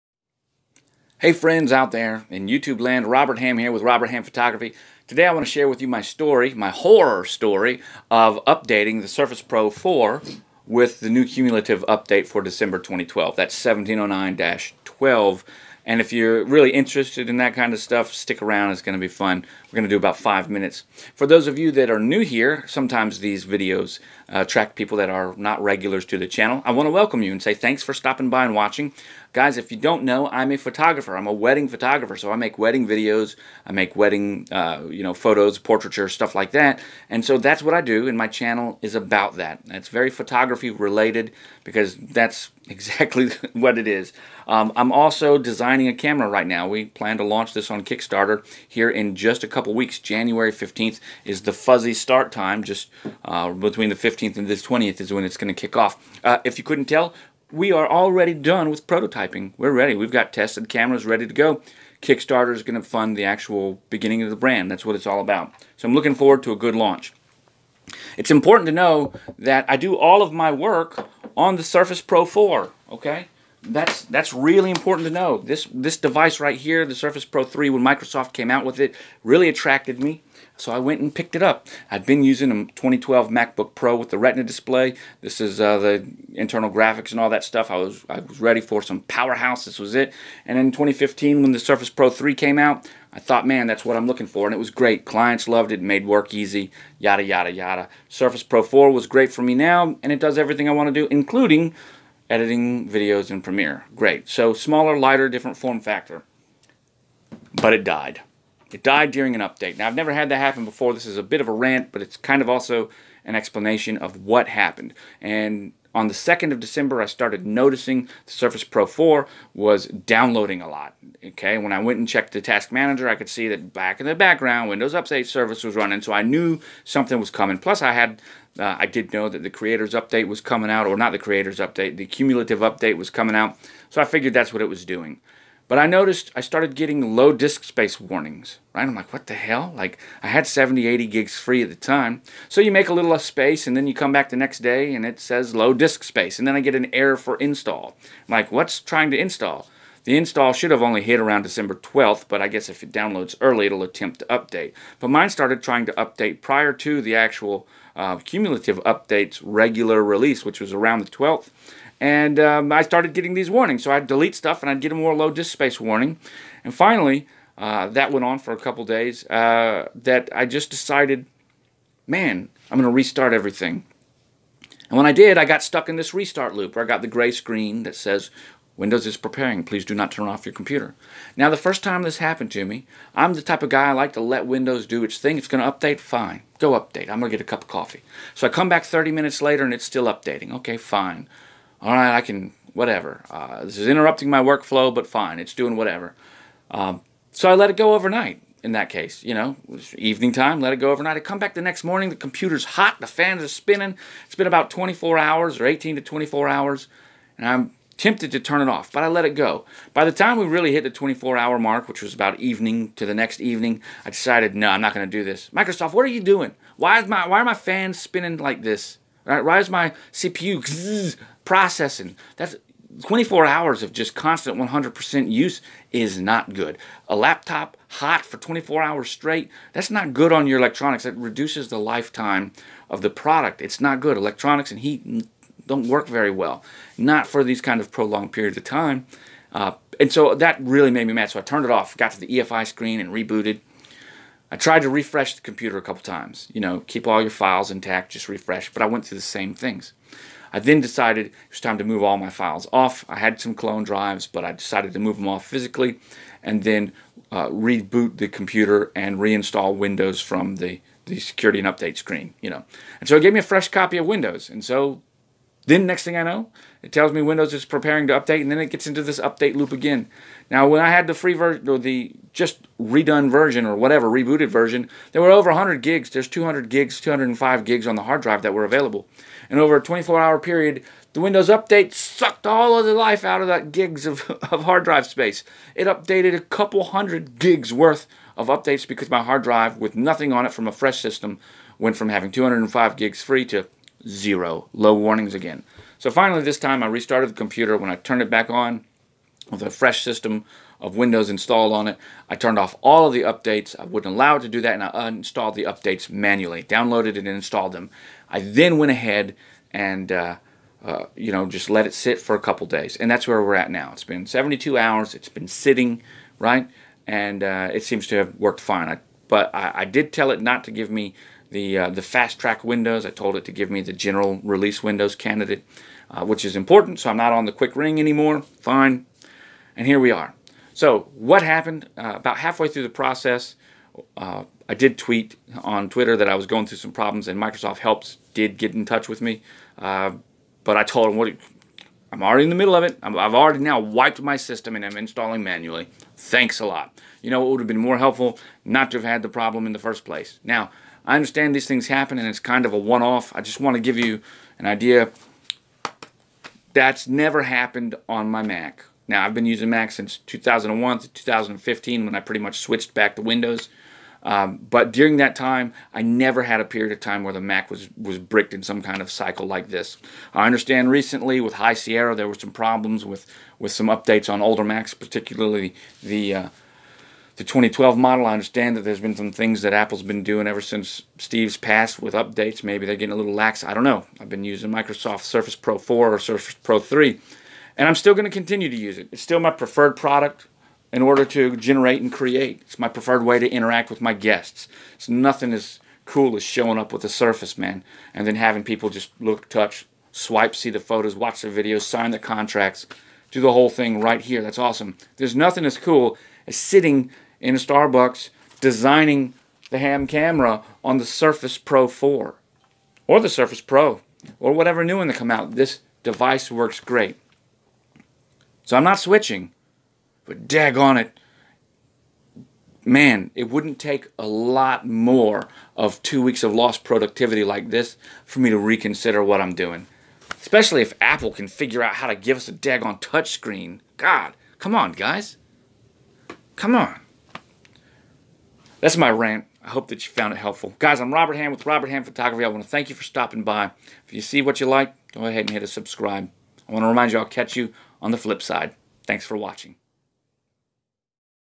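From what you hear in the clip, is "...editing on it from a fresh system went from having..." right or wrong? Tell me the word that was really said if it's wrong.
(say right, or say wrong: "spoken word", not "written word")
wrong: "nothing", not "editing".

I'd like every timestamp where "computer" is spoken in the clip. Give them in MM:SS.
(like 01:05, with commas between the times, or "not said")
03:00, 03:22, 04:05, 04:18, 04:57.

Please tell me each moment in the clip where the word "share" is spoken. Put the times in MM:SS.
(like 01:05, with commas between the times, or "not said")
00:05.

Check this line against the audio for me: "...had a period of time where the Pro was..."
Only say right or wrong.
wrong.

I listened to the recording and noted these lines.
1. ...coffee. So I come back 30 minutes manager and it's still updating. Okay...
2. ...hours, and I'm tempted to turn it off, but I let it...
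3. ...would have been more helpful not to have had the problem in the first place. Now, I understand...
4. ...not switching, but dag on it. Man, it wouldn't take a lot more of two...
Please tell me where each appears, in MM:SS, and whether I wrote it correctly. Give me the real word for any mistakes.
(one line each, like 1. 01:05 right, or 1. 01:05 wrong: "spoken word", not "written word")
1. 03:07 wrong: "later", not "manager"
2. 03:26 right
3. 05:47 right
4. 06:58 right.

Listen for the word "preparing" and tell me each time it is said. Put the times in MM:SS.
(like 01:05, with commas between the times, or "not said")
02:59, 04:27.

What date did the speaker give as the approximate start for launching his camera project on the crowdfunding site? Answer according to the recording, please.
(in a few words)
January 15th.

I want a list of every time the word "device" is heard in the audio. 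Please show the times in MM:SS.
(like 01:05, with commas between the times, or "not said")
01:15, 06:56.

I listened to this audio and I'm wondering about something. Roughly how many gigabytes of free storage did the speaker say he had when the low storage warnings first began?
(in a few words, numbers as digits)
70 to 80.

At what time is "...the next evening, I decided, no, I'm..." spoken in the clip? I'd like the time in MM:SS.
03:33.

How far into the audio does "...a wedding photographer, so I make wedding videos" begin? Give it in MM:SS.
00:31.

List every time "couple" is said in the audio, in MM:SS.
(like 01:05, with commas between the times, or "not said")
00:49, 02:48, 04:05, 04:46, 05:12.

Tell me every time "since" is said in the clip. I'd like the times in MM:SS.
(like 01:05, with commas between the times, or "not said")
05:59, 06:20.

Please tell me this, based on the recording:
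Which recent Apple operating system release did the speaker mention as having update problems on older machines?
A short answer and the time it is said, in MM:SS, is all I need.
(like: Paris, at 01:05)
High Sierra, at 06:11.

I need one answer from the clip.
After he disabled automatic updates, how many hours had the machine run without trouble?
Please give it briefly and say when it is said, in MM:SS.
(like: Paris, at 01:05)
72, at 05:14.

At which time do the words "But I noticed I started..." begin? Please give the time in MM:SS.
02:15.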